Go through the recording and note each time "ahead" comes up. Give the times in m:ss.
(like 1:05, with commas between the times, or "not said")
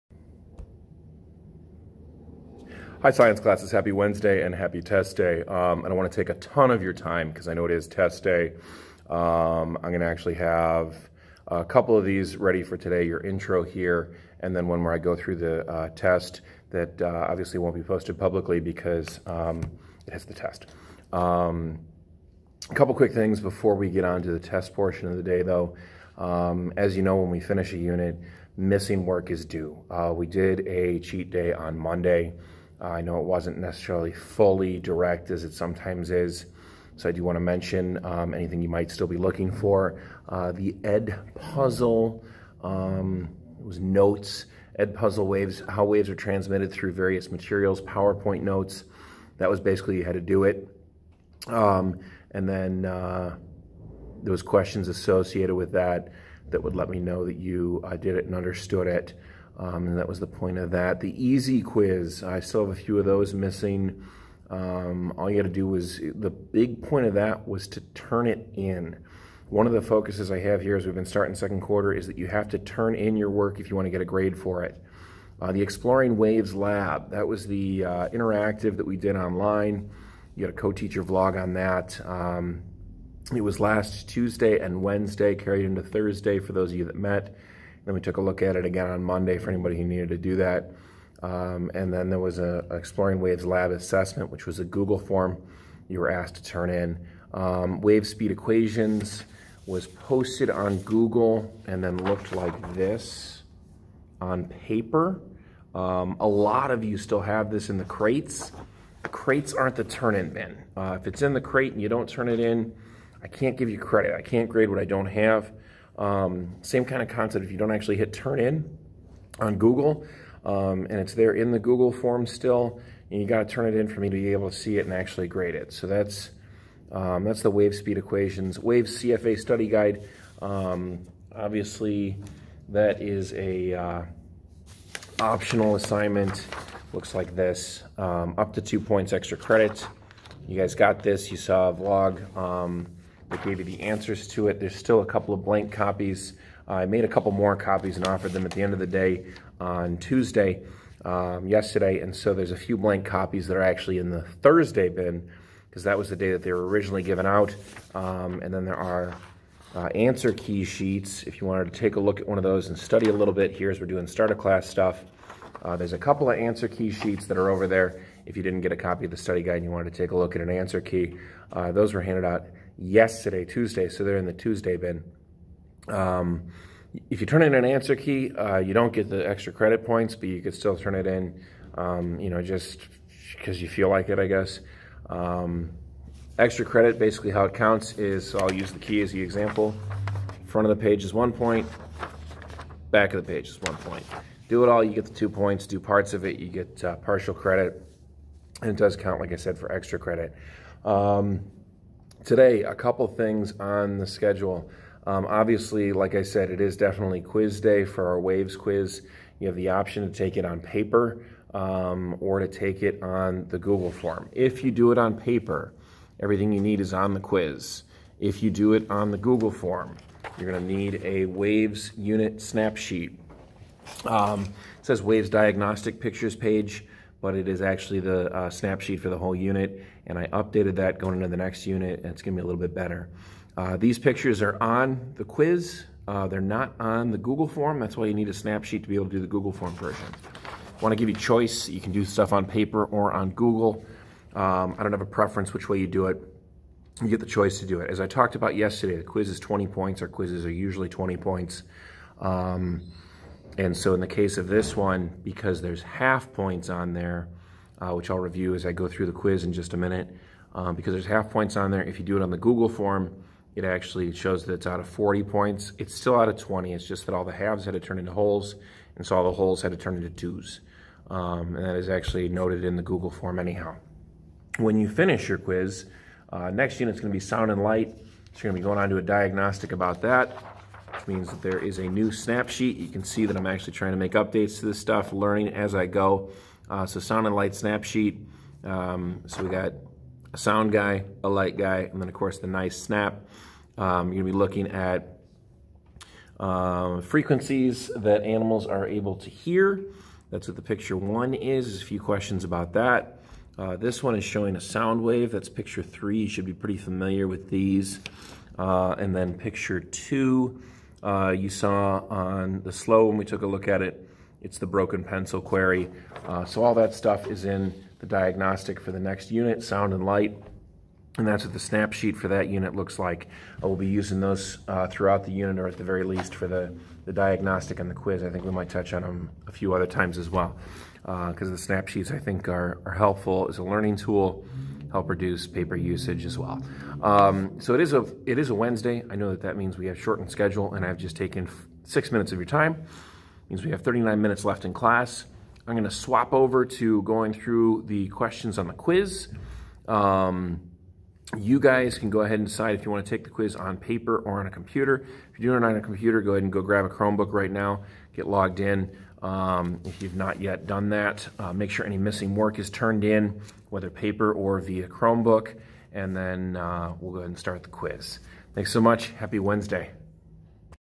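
5:52, 5:56, 6:07.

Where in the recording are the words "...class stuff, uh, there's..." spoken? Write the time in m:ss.
2:44.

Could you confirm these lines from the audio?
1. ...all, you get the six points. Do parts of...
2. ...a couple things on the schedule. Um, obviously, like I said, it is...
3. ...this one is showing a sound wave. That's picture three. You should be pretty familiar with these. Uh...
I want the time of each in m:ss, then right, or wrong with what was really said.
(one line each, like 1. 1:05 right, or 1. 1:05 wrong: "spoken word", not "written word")
1. 3:14 wrong: "two", not "six"
2. 3:22 right
3. 5:03 right.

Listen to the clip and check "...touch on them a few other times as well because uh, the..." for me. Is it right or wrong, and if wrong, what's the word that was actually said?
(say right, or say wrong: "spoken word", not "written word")
right.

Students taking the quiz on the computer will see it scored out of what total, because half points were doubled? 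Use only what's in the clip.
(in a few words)
40 points.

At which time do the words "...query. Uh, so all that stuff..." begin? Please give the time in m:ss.
5:15.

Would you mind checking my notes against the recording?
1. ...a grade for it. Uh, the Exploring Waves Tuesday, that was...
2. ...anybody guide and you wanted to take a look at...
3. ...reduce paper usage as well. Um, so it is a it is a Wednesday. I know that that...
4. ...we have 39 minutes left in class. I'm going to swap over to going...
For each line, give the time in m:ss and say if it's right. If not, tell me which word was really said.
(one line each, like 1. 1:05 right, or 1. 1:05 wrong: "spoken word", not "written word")
1. 1:14 wrong: "Lab", not "Tuesday"
2. 2:49 wrong: "study", not "anybody"
3. 5:35 right
4. 5:43 right.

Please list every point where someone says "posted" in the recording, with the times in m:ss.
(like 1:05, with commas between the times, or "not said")
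0:17, 1:39.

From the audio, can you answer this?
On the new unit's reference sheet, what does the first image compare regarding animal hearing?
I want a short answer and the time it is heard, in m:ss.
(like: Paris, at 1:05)
Frequencies, at 4:57.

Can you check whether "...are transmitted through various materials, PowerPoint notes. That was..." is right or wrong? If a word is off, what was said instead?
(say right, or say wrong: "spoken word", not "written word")
right.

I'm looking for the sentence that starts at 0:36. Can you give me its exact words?
So I do want to mention um, anything you might still be looking for.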